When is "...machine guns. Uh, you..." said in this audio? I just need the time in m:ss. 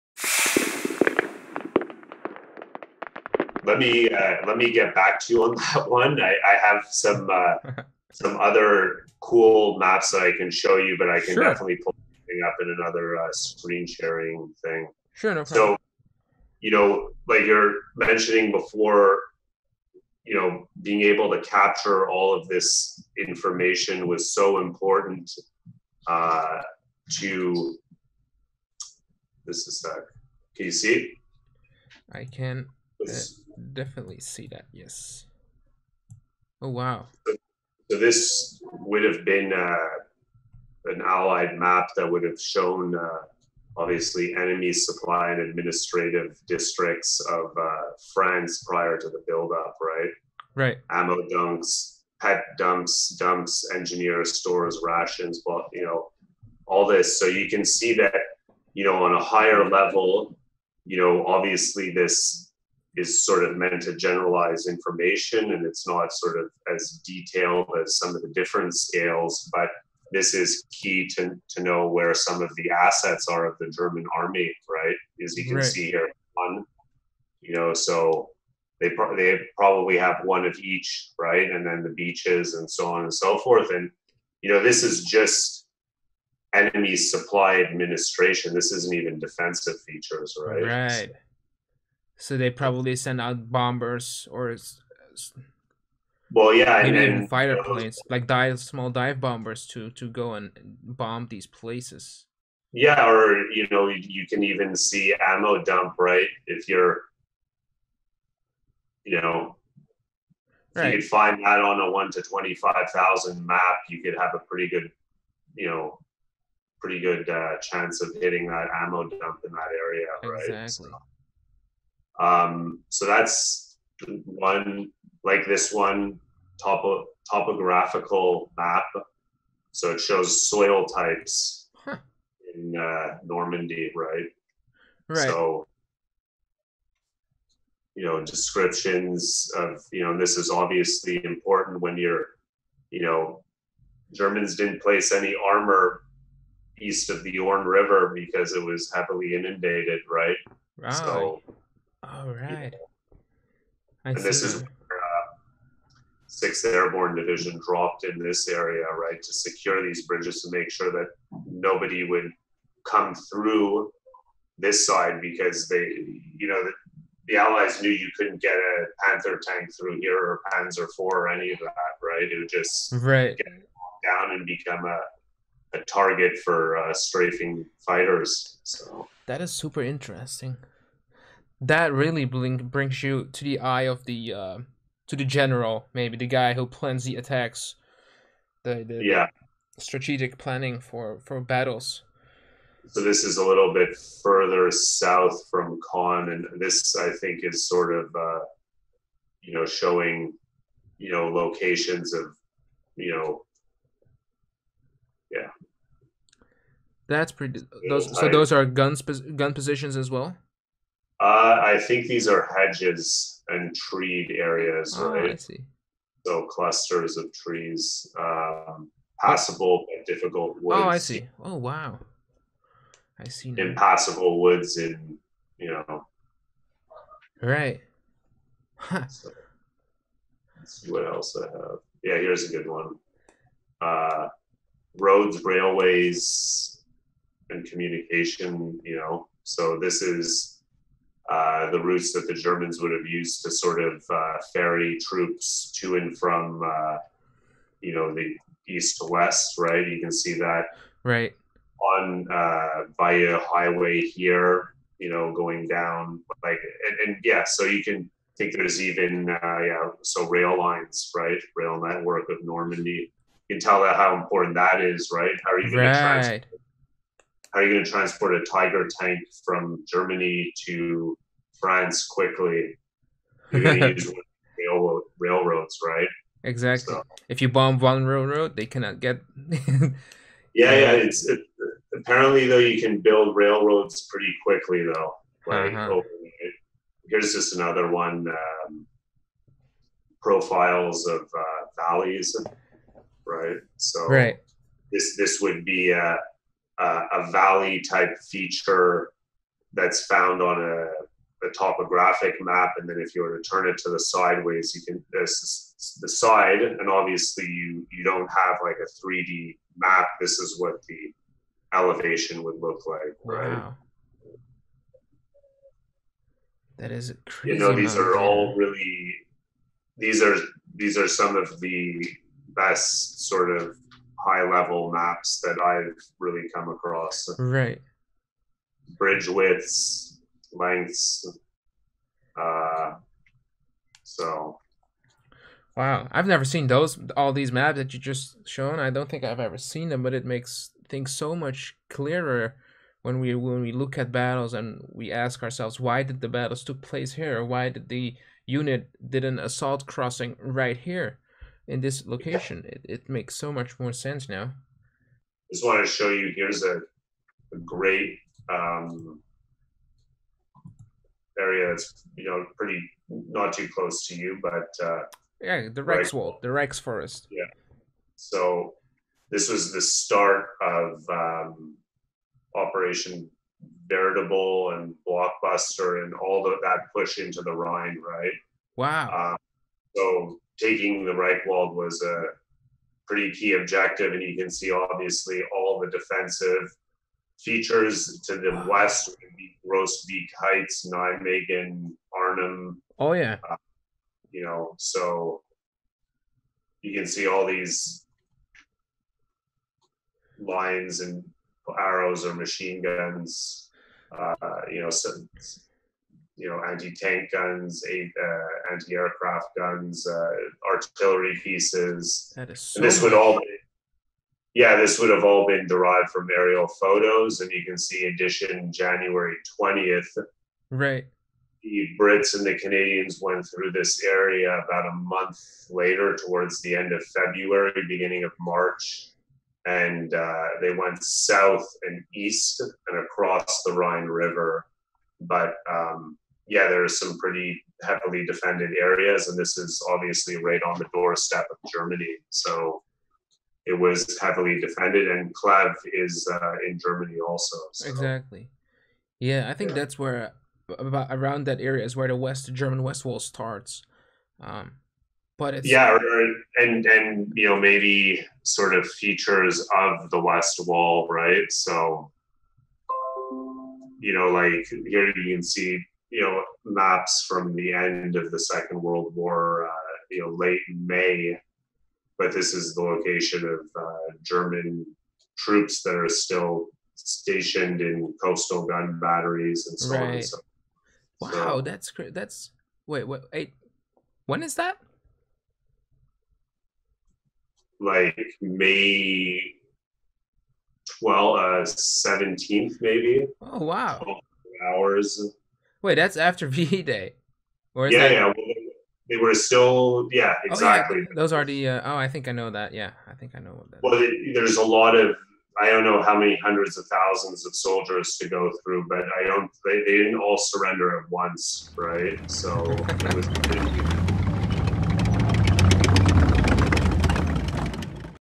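6:42.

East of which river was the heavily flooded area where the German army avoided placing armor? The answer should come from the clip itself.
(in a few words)
Orne River.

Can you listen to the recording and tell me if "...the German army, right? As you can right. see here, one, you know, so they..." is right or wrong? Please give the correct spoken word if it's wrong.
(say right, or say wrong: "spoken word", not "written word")
right.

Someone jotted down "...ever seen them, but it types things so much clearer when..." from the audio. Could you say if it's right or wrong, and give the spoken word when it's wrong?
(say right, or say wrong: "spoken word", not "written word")
wrong: "makes", not "types".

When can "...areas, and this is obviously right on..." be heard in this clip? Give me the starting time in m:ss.
7:18.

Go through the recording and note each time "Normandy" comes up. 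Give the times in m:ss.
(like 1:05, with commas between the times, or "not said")
2:13, 4:22.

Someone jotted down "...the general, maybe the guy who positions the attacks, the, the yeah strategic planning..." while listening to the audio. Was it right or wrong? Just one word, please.
wrong.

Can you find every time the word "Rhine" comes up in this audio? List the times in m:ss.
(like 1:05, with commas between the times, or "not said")
6:17, 7:13.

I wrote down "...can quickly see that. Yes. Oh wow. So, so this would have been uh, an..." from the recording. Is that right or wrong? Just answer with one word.
wrong.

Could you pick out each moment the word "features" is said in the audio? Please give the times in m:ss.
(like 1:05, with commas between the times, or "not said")
1:29, 4:58, 6:27, 7:38.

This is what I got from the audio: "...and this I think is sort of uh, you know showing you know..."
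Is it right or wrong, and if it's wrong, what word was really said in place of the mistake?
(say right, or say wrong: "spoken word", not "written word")
right.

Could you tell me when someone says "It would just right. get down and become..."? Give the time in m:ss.
2:52.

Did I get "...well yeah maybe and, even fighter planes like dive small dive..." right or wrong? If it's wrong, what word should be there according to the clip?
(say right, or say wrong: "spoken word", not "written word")
right.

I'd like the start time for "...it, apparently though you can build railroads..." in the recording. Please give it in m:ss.
4:41.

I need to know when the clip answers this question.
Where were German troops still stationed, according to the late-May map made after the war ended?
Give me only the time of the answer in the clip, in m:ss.
7:58.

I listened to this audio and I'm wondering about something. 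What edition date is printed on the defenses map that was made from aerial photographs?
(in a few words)
January 20.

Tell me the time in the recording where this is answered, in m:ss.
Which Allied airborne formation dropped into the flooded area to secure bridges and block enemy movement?
2:36.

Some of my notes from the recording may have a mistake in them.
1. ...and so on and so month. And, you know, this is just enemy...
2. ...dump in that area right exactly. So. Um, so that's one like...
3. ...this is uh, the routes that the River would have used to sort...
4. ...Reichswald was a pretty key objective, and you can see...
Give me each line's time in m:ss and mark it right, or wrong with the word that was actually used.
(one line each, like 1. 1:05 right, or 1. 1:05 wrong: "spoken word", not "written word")
1. 1:22 wrong: "forth", not "month"
2. 1:59 right
3. 3:59 wrong: "Germans", not "River"
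4. 6:21 right.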